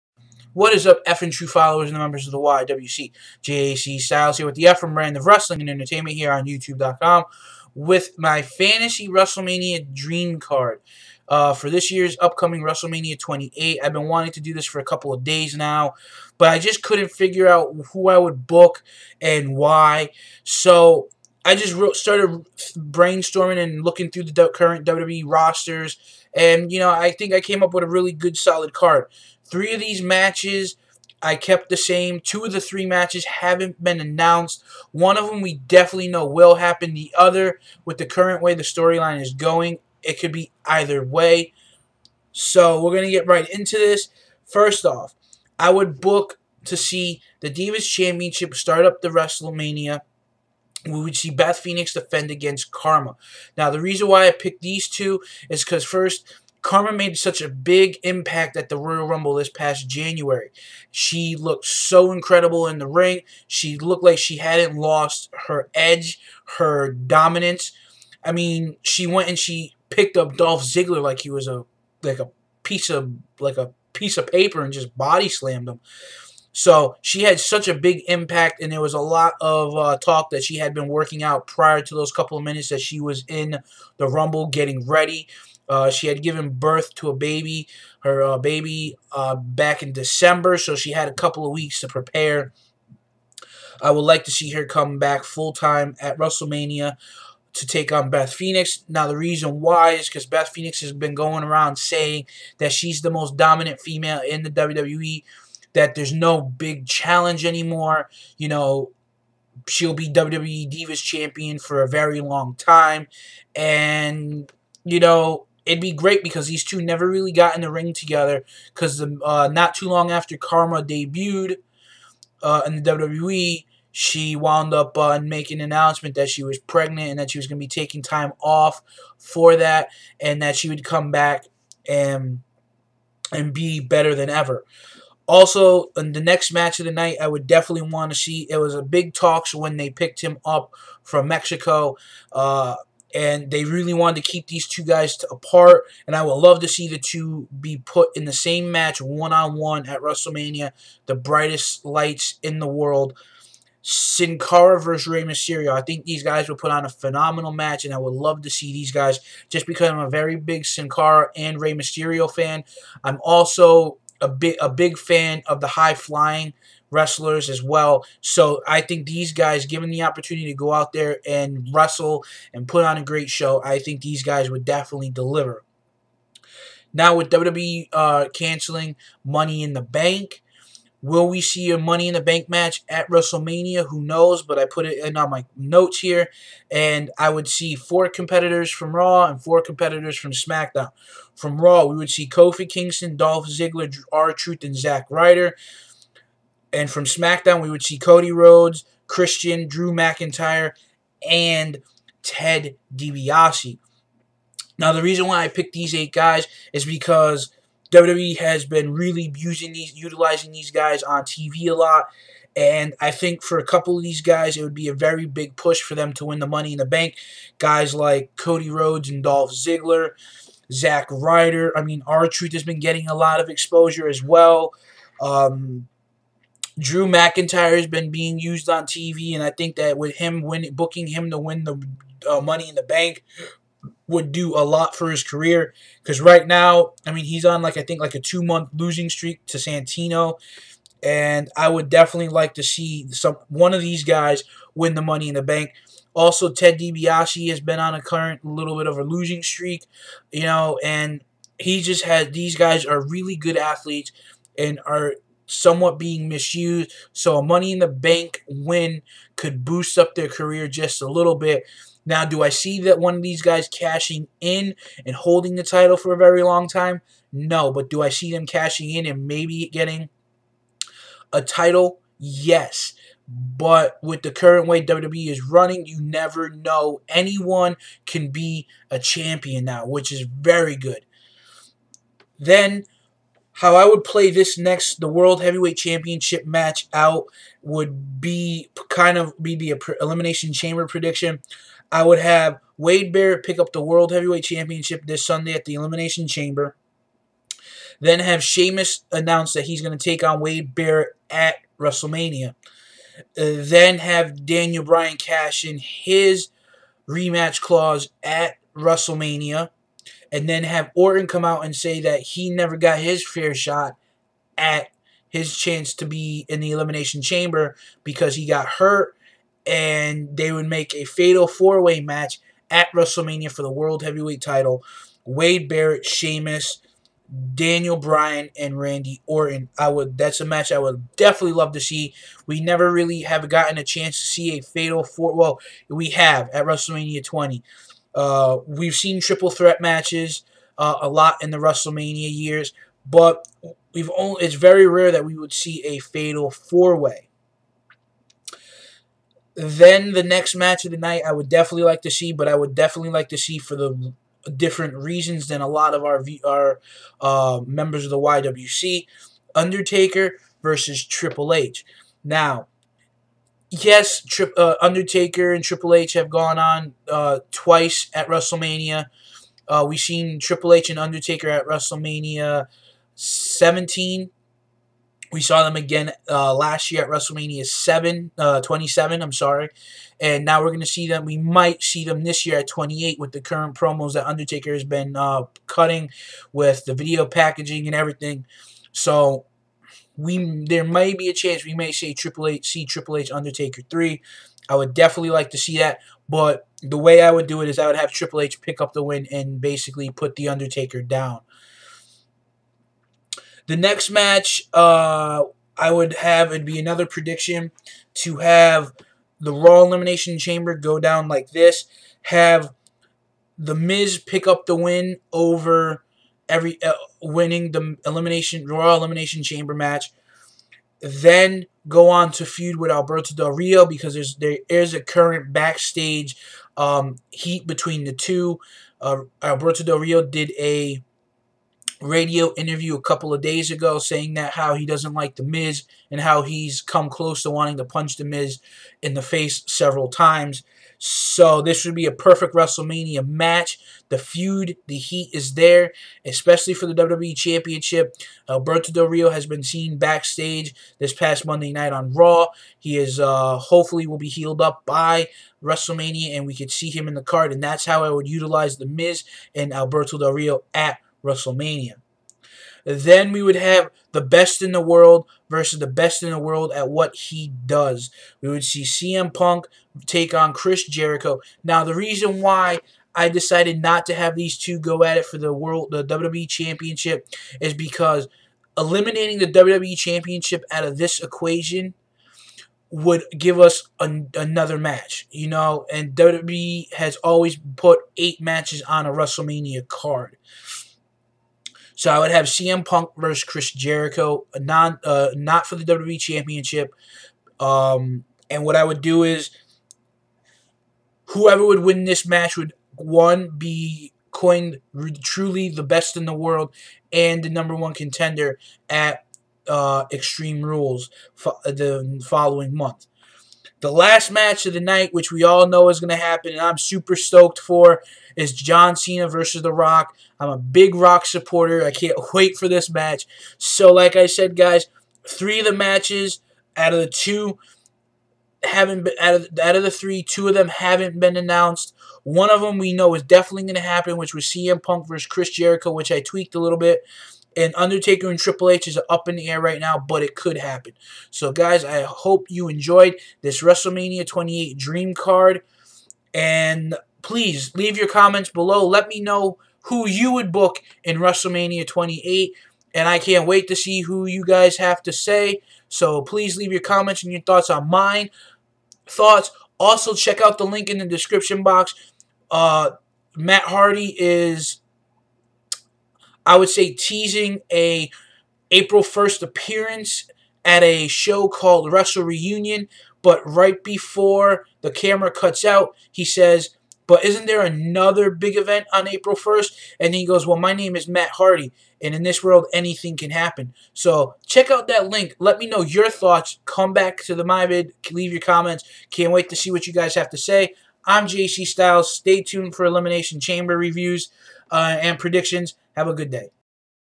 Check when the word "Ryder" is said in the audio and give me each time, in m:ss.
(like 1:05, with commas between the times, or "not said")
3:15, 3:41.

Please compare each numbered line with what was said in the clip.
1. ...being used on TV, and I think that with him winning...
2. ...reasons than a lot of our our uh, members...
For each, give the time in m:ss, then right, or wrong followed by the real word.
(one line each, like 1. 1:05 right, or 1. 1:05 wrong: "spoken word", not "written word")
1. 3:48 right
2. 5:54 right.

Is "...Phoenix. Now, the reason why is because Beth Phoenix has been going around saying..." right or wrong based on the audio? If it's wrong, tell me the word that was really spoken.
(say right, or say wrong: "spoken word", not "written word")
right.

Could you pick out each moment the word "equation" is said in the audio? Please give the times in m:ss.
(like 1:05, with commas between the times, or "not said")
8:01.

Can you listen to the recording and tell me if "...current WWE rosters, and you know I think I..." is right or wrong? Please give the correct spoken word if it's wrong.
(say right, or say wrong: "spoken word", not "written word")
right.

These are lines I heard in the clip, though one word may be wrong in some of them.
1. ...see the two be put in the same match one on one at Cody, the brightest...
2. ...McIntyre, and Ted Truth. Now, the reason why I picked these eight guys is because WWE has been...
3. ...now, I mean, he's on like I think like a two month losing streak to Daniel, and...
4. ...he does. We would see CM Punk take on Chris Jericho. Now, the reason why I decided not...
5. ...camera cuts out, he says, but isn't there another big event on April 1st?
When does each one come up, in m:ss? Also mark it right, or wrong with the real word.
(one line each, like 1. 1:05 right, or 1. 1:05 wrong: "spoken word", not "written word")
1. 2:26 wrong: "WrestleMania", not "Cody"
2. 3:19 wrong: "DiBiase", not "Truth"
3. 3:56 wrong: "Santino", not "Daniel"
4. 7:47 right
5. 9:34 right.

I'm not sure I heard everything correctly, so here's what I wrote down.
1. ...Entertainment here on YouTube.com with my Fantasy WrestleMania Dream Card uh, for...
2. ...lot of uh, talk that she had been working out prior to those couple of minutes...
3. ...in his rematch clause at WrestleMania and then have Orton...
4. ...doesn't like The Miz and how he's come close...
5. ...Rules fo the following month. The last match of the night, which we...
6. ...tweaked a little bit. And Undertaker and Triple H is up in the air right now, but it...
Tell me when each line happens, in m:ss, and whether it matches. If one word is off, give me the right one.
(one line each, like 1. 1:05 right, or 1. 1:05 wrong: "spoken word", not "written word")
1. 0:05 right
2. 1:18 right
3. 5:05 right
4. 7:14 right
5. 8:30 right
6. 8:56 right.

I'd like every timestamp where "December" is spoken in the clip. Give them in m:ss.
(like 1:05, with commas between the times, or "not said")
1:29.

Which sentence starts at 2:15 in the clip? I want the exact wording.
Also, in the next match of the night, I would definitely want to see.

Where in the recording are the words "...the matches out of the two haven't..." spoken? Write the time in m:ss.
8:45.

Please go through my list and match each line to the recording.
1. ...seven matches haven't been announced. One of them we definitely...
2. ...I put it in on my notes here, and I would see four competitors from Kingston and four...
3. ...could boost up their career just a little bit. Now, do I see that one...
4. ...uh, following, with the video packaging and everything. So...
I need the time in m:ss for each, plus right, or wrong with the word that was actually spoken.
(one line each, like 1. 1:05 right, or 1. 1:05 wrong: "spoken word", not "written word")
1. 0:32 wrong: "three", not "seven"
2. 3:04 wrong: "Raw", not "Kingston"
3. 4:19 right
4. 6:25 wrong: "cutting", not "following".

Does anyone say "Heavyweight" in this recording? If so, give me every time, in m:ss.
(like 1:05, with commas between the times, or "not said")
4:45, 4:54, 5:24.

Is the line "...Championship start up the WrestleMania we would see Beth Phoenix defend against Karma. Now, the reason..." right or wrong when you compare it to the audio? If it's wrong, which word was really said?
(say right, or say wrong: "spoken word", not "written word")
right.